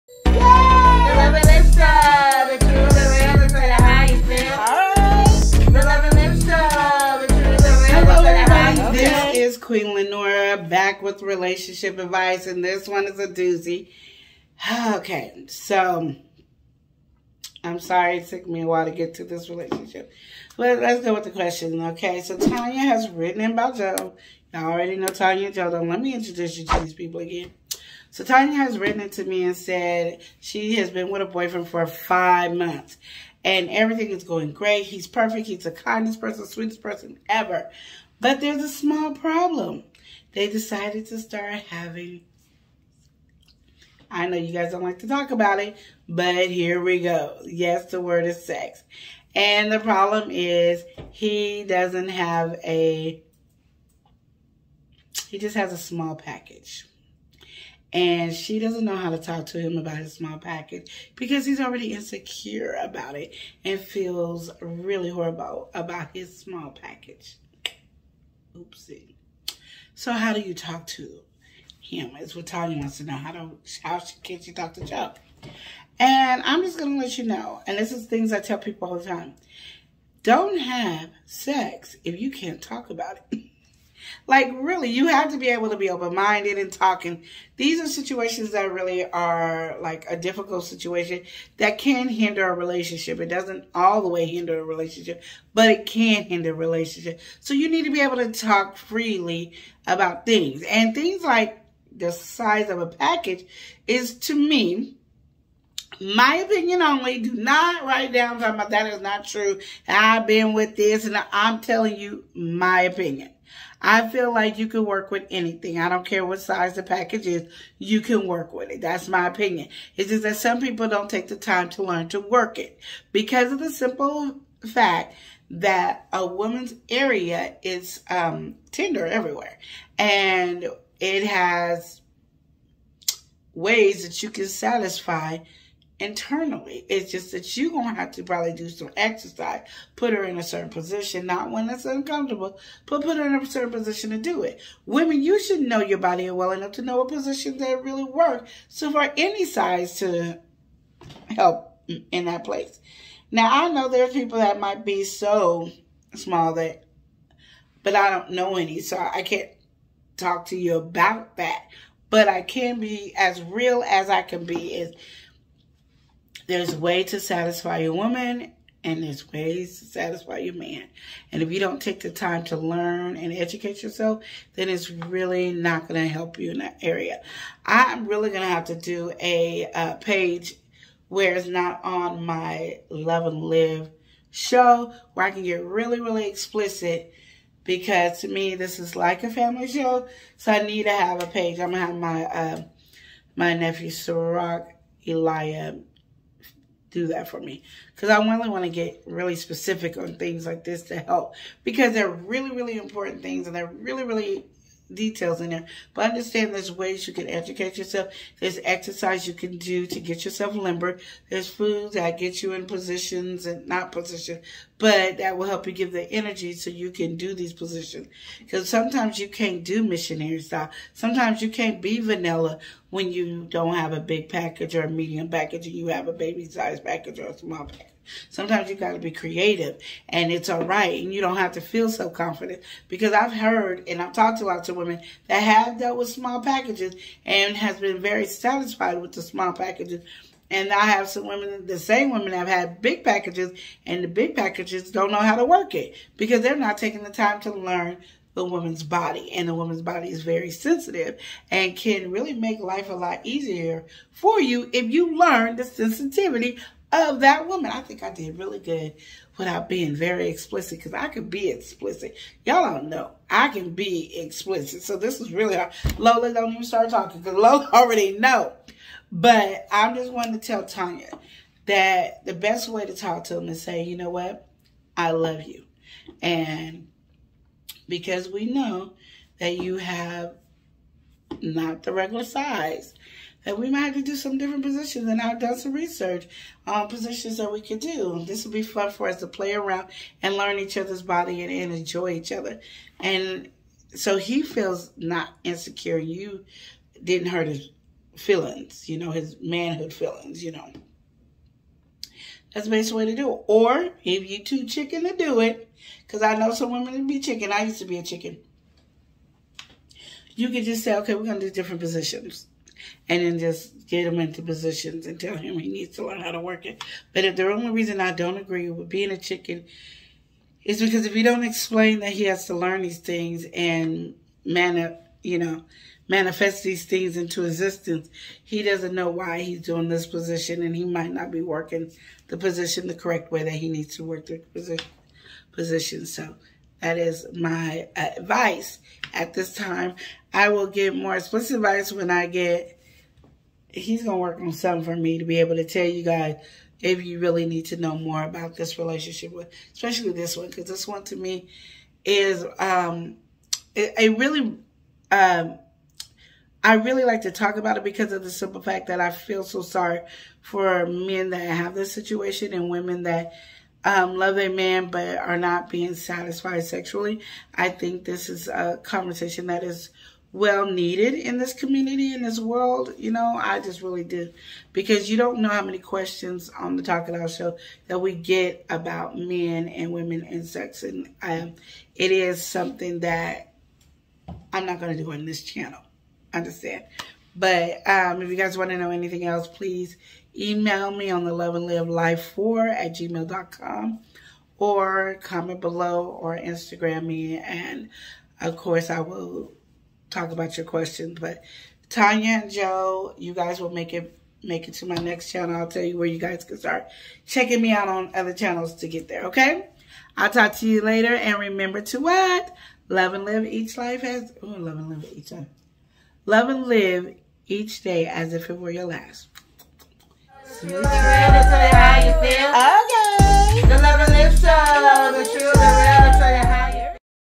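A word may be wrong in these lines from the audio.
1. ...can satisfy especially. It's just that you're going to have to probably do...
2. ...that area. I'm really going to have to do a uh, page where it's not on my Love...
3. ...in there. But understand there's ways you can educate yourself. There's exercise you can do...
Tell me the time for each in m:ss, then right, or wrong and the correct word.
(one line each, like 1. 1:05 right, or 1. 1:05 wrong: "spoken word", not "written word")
1. 2:14 wrong: "internally", not "especially"
2. 2:56 right
3. 3:25 right.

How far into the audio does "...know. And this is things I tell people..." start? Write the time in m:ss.
1:17.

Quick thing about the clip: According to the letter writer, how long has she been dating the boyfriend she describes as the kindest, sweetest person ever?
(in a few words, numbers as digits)
5 months.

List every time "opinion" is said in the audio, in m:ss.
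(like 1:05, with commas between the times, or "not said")
1:46, 1:52, 1:59.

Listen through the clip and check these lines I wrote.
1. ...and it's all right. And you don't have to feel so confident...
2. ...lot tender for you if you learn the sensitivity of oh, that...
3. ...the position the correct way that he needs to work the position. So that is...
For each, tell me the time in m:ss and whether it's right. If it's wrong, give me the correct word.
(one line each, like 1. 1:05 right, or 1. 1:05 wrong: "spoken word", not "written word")
1. 3:50 right
2. 4:12 wrong: "easier", not "tender"
3. 5:32 right.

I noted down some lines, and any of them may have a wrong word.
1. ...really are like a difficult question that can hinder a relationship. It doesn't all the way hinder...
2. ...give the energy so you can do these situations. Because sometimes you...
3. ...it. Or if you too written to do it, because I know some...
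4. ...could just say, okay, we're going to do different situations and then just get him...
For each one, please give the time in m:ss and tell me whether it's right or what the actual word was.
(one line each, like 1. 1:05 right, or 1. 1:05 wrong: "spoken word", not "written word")
1. 1:28 wrong: "situation", not "question"
2. 3:35 wrong: "positions", not "situations"
3. 5:03 wrong: "chicken", not "written"
4. 5:10 wrong: "positions", not "situations".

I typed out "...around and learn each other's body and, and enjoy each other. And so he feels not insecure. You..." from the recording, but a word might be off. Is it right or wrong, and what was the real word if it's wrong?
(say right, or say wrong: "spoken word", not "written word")
right.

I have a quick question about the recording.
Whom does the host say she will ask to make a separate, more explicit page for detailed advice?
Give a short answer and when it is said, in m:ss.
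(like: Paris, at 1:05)
Sirach Eliah, at 3:13.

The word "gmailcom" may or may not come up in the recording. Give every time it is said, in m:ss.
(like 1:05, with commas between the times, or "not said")
6:32.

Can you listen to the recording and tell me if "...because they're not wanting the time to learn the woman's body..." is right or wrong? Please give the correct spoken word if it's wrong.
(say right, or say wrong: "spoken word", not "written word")
wrong: "taking", not "wanting".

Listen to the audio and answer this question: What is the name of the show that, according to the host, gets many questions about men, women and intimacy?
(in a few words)
Talk It Out.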